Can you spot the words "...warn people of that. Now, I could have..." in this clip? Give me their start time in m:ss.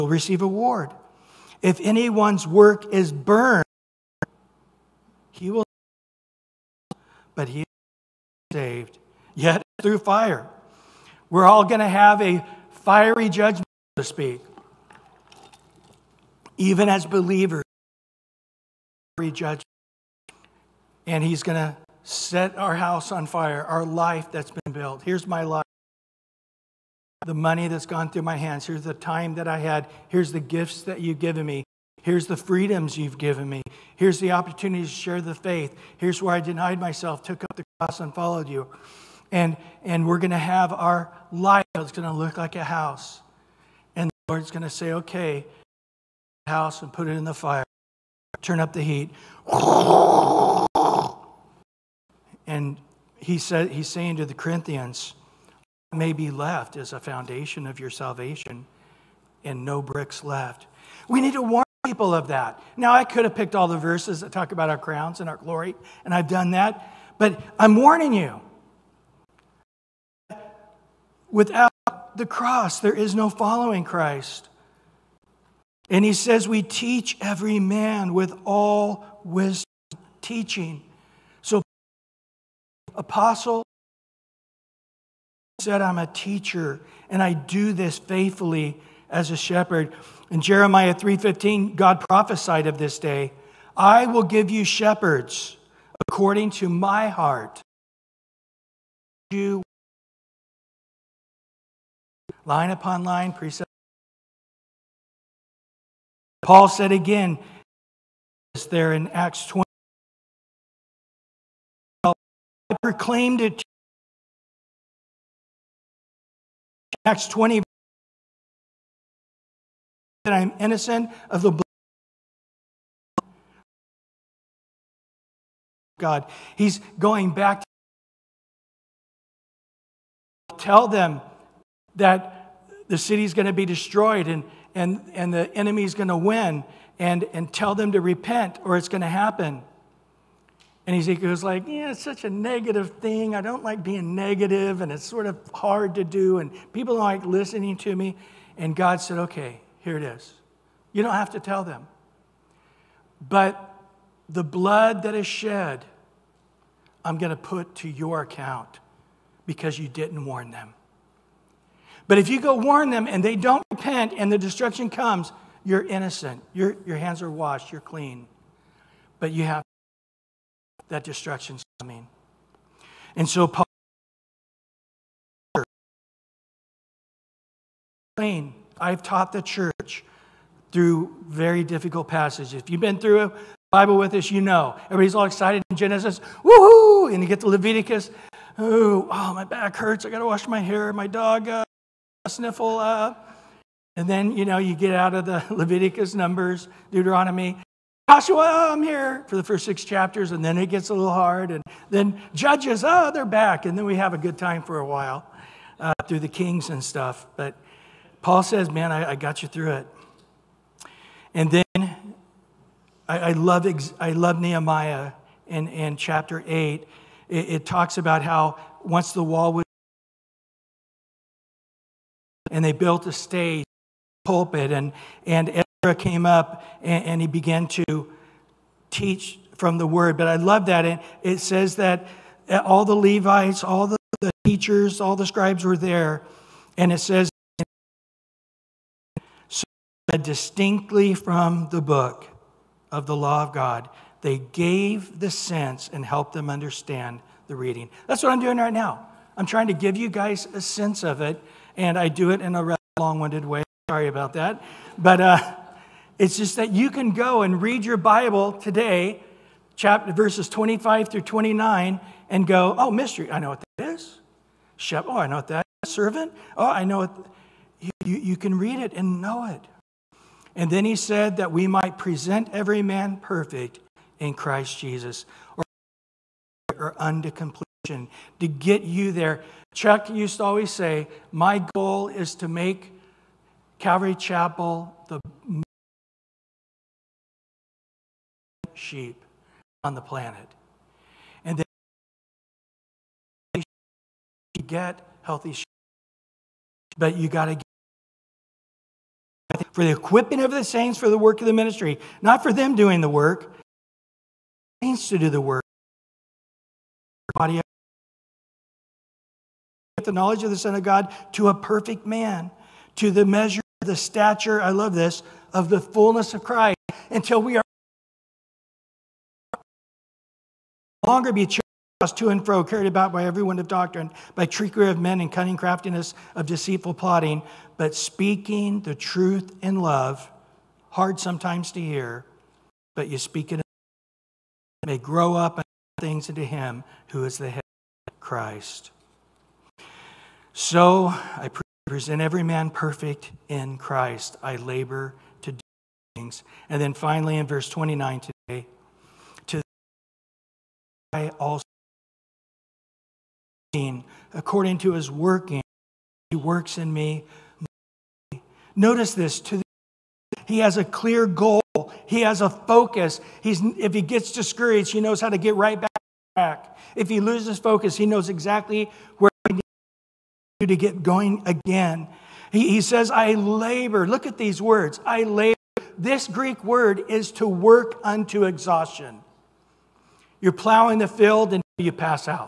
1:01.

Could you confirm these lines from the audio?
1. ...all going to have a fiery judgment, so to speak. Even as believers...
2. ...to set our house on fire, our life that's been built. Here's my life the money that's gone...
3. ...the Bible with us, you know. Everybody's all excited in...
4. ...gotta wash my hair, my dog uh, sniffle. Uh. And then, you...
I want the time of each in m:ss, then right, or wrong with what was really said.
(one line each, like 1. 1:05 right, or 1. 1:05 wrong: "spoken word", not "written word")
1. 0:11 right
2. 0:21 right
3. 3:03 right
4. 3:10 right.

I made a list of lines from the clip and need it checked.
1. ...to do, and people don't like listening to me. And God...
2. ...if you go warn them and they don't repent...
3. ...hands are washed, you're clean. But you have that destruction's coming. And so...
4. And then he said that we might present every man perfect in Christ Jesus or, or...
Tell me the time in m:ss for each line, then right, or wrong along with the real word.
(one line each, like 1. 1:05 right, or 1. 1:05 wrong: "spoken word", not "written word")
1. 2:25 right
2. 2:42 right
3. 2:46 right
4. 4:30 right.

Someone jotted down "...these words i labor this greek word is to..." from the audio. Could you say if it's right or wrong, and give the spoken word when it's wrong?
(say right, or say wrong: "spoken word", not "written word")
right.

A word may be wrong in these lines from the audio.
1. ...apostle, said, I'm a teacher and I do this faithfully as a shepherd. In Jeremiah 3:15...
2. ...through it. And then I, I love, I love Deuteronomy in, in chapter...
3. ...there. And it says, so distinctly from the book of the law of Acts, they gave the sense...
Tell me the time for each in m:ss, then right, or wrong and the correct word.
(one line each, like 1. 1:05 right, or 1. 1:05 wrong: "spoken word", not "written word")
1. 1:22 right
2. 3:29 wrong: "Nehemiah", not "Deuteronomy"
3. 3:55 wrong: "God", not "Acts".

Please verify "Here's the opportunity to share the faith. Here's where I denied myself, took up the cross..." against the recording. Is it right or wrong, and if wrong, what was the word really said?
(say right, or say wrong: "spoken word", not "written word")
right.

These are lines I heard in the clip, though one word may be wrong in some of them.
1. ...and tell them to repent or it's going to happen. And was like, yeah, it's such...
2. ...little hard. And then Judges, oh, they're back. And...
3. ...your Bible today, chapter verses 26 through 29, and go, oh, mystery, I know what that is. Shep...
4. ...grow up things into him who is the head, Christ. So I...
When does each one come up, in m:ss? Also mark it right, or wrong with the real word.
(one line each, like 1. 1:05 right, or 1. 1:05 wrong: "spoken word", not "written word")
1. 2:17 right
2. 3:20 right
3. 4:17 wrong: "25", not "26"
4. 5:34 right.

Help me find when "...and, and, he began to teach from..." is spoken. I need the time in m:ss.
3:46.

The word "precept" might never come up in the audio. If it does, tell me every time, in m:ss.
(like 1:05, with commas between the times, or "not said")
1:43.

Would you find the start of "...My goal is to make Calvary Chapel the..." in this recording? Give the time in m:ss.
4:41.